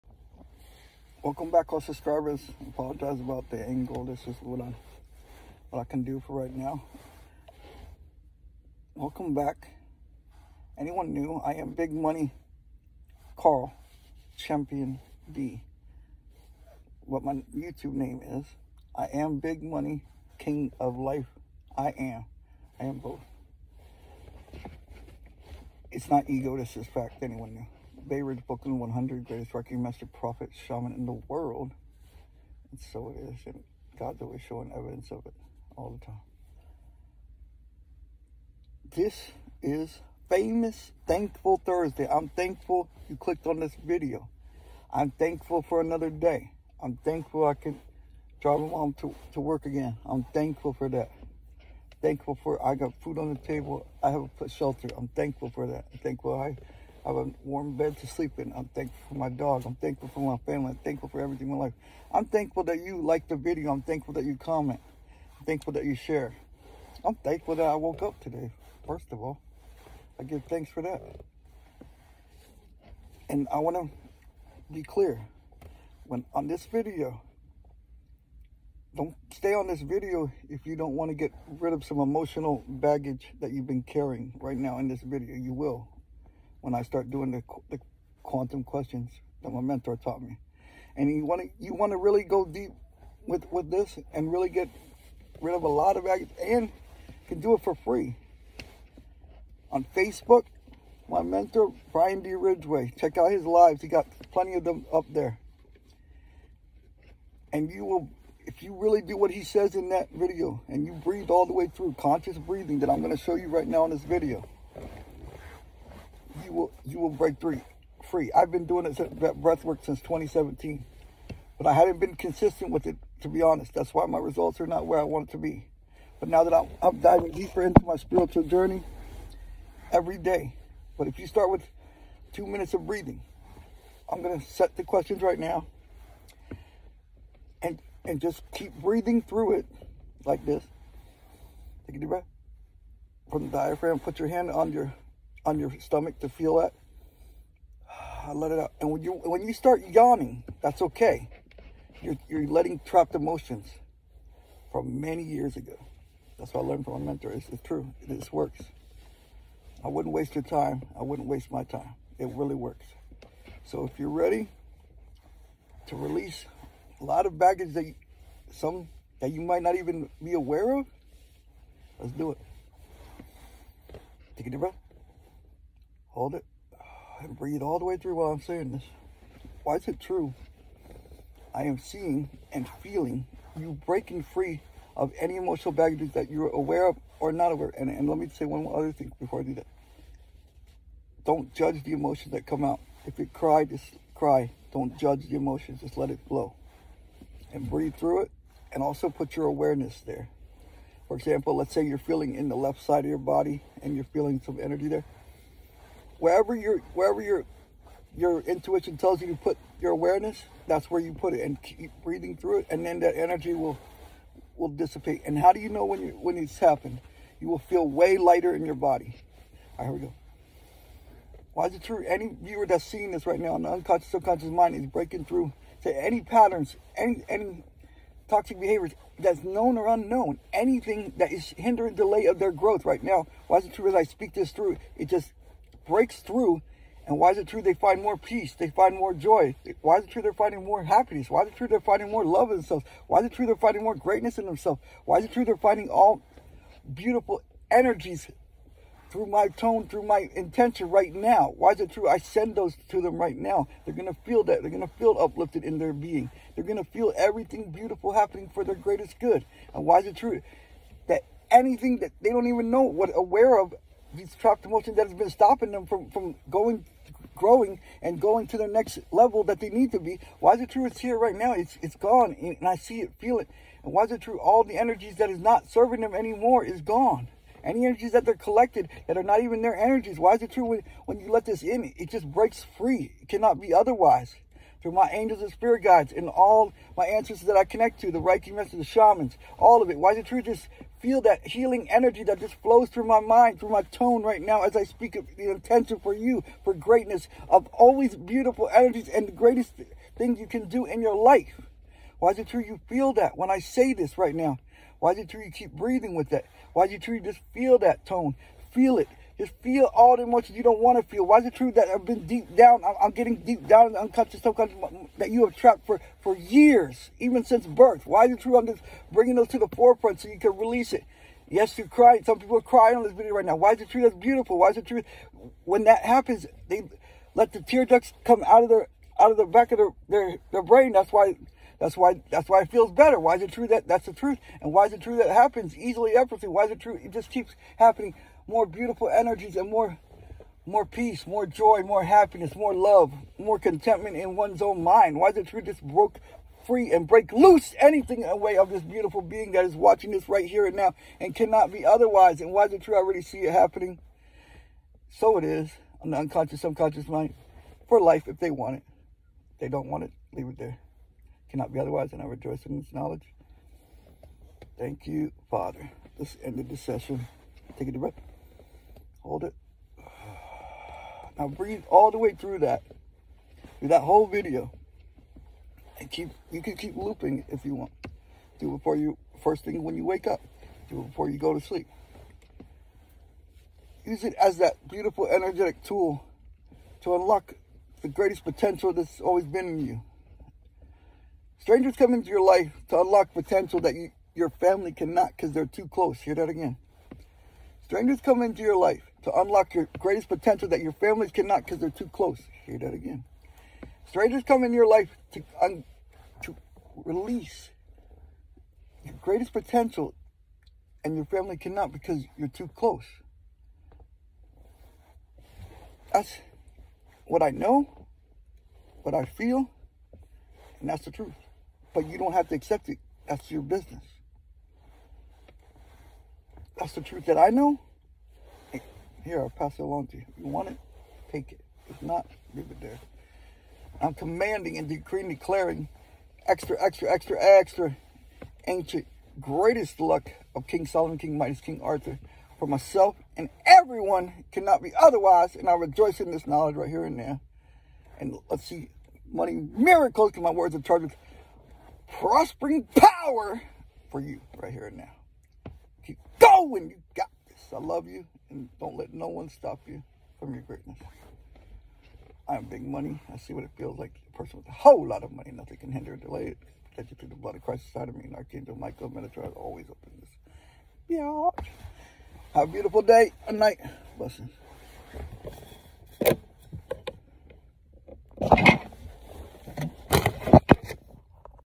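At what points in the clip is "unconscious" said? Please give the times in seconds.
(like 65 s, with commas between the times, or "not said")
223 s, 314 s, 356 s.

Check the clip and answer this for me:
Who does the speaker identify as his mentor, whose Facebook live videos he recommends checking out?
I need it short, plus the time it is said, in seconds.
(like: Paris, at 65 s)
Brian D. Ridgway, at 101 s.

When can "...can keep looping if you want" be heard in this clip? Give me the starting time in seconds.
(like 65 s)
376 s.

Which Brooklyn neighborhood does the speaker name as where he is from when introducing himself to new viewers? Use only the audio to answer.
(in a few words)
Bay Ridge.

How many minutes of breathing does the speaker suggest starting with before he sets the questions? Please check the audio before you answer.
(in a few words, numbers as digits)
2.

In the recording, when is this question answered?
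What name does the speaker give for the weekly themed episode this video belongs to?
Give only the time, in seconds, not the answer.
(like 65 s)
41 s.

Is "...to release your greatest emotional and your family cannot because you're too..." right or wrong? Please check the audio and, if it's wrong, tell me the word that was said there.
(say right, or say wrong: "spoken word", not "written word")
wrong: "potential", not "emotional".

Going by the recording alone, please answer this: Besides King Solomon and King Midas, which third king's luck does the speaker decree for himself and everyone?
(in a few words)
King Arthur.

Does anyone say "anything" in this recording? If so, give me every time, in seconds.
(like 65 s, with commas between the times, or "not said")
230 s, 261 s, 347 s.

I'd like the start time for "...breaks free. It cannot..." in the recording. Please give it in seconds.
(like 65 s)
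282 s.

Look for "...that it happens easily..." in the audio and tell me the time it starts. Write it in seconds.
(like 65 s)
335 s.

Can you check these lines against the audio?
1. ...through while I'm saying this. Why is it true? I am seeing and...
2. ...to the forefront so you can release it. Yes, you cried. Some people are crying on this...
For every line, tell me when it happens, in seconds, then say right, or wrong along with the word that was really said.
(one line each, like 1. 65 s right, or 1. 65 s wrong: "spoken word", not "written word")
1. 177 s right
2. 319 s right.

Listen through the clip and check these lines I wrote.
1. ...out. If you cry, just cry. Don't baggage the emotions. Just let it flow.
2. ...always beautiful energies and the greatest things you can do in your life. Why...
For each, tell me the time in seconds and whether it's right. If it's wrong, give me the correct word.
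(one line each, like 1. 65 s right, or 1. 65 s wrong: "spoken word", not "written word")
1. 192 s wrong: "judge", not "baggage"
2. 297 s right.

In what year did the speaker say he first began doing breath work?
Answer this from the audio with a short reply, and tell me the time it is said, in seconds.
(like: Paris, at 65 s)
2017, at 120 s.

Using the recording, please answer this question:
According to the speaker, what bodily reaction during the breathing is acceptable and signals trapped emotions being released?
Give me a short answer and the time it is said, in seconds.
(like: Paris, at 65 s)
Yawning, at 149 s.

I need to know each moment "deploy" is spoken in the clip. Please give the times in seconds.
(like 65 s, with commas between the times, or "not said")
not said.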